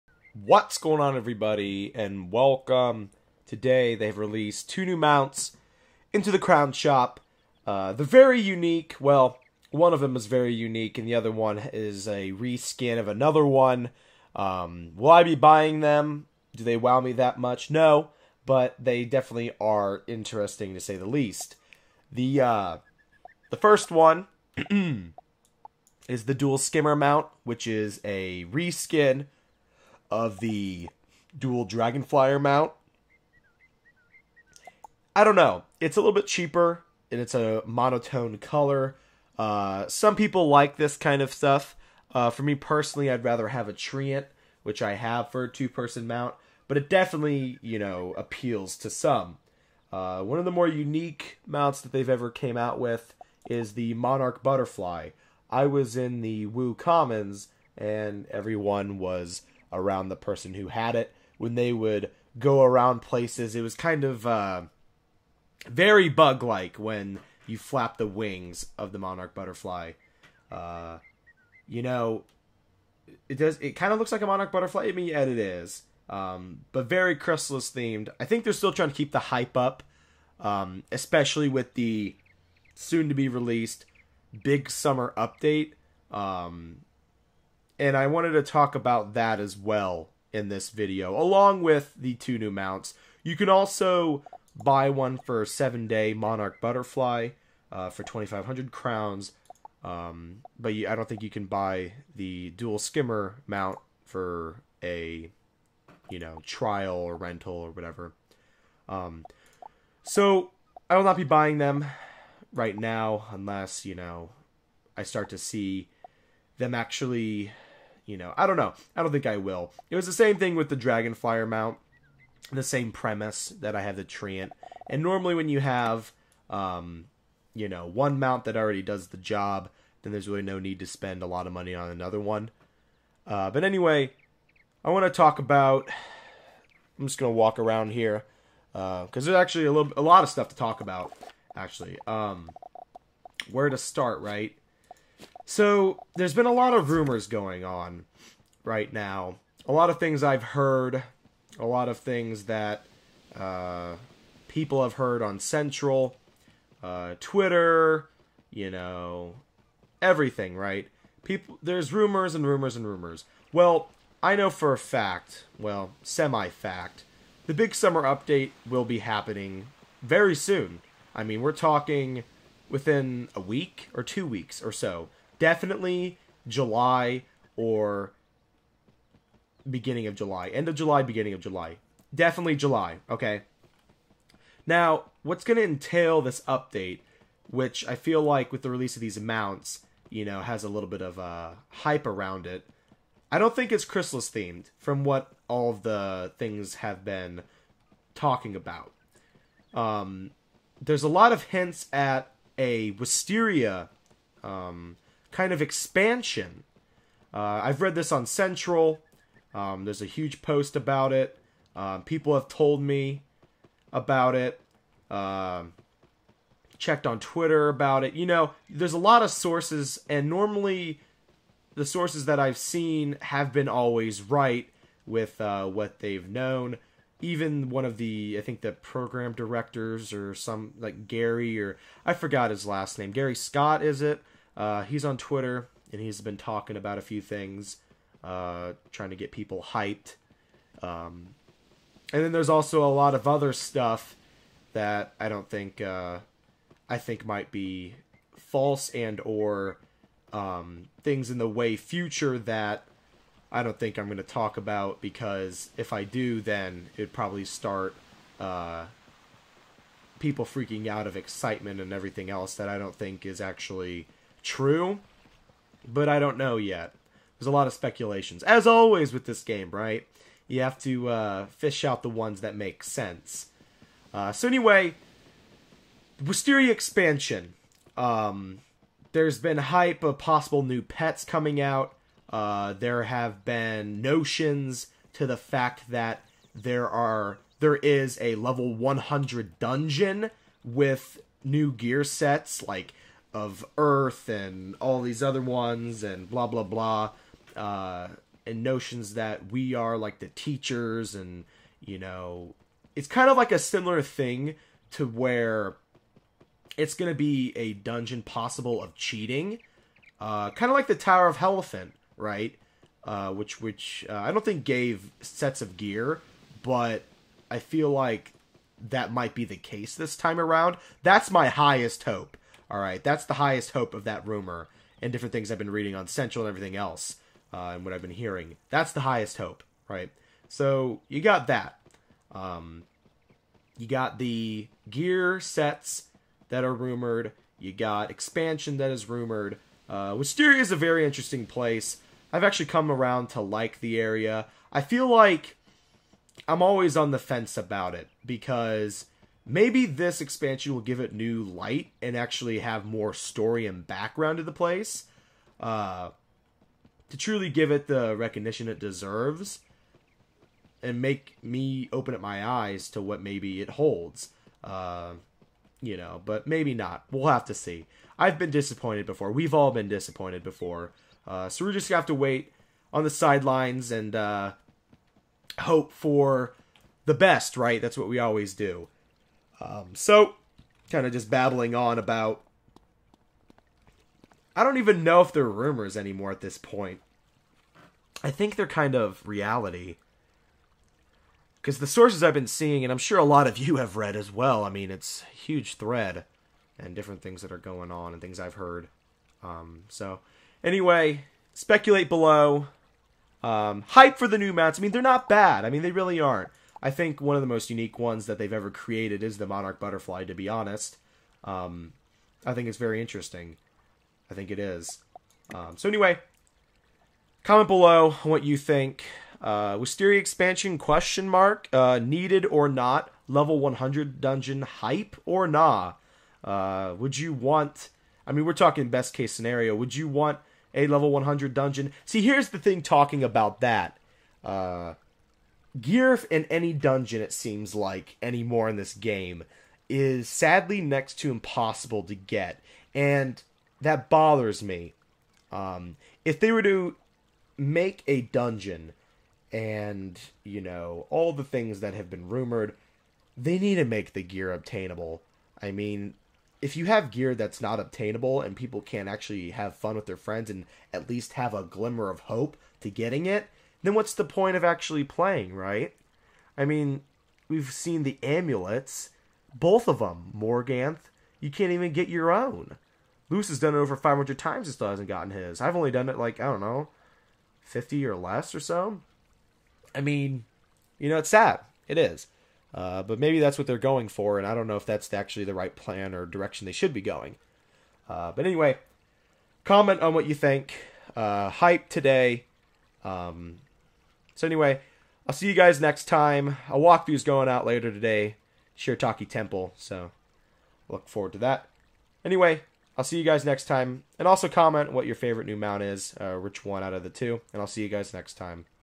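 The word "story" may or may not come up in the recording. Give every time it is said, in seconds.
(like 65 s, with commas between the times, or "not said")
353 s.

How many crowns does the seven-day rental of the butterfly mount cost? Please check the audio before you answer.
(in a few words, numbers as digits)
2,500.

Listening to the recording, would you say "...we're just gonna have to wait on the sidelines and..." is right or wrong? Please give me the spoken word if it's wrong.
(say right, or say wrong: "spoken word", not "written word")
right.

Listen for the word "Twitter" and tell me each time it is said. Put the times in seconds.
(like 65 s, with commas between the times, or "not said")
157 s, 217 s, 235 s.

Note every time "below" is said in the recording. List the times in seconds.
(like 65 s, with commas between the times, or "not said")
402 s, 417 s.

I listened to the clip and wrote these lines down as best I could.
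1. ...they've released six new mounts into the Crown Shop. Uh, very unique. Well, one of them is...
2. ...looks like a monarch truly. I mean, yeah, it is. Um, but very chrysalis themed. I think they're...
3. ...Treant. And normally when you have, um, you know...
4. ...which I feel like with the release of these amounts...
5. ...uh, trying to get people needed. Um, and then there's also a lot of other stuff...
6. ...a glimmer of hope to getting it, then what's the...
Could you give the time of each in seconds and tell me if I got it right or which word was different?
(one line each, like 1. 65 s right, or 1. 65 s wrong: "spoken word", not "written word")
1. 3 s wrong: "two", not "six"
2. 73 s wrong: "butterfly", not "truly"
3. 124 s right
4. 187 s right
5. 238 s wrong: "hyped", not "needed"
6. 461 s right.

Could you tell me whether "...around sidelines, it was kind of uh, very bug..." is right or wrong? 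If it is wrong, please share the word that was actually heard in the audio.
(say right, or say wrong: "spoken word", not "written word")
wrong: "places", not "sidelines".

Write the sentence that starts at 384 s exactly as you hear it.
I don't even know if they're rumors anymore at this point.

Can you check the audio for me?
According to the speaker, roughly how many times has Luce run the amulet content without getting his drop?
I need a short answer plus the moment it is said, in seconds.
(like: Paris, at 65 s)
Over 500, at 473 s.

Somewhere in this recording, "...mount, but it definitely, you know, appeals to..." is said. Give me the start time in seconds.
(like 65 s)
46 s.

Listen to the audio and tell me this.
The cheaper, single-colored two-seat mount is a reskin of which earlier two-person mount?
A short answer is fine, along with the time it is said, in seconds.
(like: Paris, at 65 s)
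Dual Dragonflyer mount, at 30 s.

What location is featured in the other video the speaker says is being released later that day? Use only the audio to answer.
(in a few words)
Shirataki Temple.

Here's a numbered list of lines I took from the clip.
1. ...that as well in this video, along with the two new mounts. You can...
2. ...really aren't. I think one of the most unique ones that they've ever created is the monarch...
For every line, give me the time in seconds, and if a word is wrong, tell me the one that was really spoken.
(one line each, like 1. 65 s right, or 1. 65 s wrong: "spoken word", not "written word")
1. 89 s right
2. 405 s right.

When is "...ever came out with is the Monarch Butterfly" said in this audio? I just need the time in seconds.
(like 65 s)
52 s.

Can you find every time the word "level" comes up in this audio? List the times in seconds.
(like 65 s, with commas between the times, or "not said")
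288 s, 423 s, 430 s.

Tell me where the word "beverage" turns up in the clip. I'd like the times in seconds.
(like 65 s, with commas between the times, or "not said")
not said.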